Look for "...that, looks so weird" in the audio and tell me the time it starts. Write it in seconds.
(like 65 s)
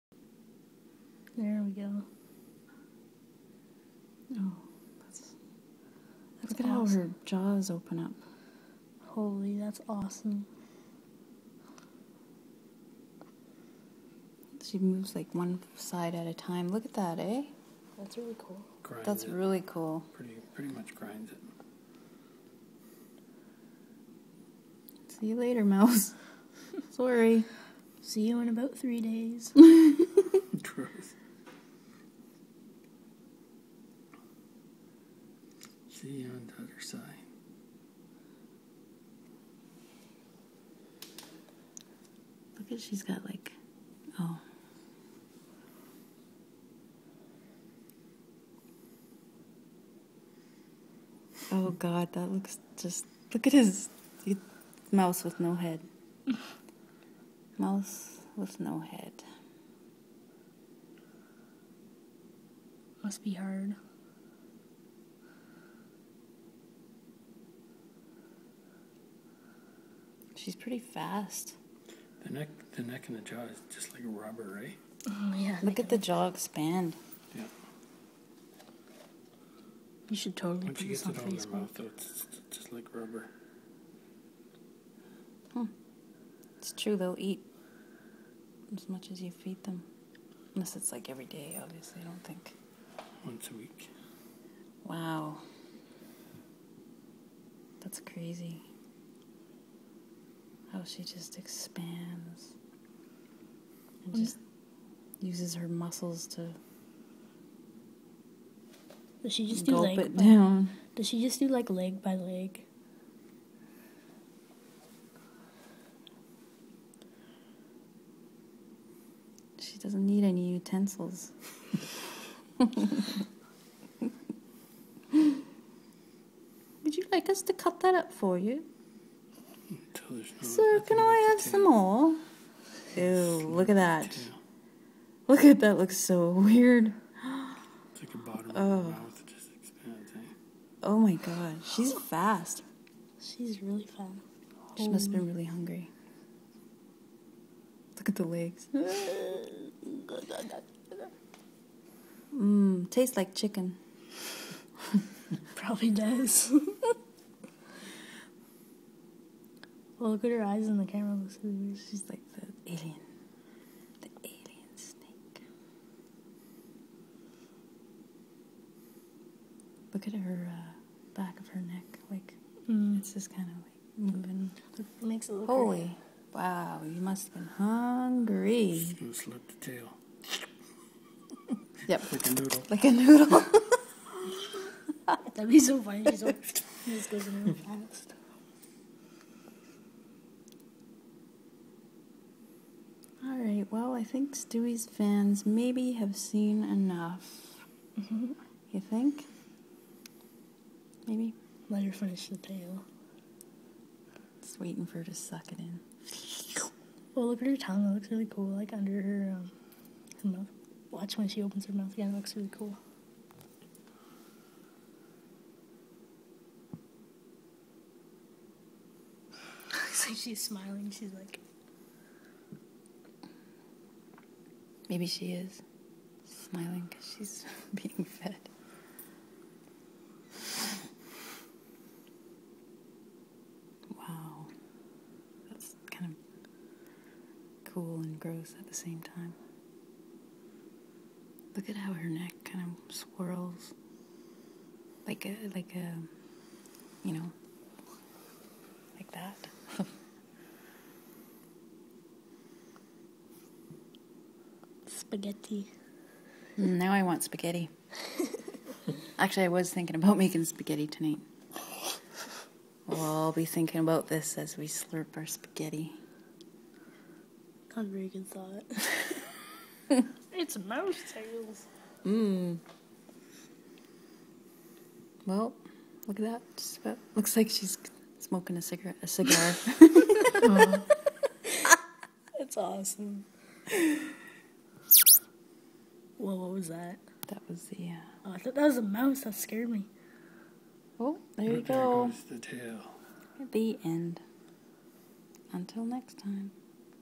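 135 s.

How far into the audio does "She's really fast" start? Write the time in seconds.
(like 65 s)
143 s.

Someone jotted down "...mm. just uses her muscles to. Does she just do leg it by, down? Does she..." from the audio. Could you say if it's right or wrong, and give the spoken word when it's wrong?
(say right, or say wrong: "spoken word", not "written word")
right.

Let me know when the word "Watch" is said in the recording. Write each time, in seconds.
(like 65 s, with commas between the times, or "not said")
210 s.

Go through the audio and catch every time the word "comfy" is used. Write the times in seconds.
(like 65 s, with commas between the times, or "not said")
not said.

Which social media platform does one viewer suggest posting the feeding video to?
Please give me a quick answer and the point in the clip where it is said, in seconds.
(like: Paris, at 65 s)
Facebook, at 81 s.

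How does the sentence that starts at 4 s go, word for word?
Oh, that's, that's Look at awesome.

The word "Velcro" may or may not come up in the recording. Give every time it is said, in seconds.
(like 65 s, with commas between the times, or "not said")
not said.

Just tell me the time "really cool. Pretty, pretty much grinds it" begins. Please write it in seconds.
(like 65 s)
19 s.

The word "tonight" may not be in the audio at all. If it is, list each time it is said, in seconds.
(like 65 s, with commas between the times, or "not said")
260 s.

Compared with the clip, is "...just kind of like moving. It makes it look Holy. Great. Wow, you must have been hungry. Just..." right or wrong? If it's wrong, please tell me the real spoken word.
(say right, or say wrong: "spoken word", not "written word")
right.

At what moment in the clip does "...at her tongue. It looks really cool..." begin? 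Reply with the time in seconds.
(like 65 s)
207 s.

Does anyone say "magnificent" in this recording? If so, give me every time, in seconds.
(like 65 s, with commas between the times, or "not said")
not said.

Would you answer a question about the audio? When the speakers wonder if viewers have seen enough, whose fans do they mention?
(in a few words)
Stewie.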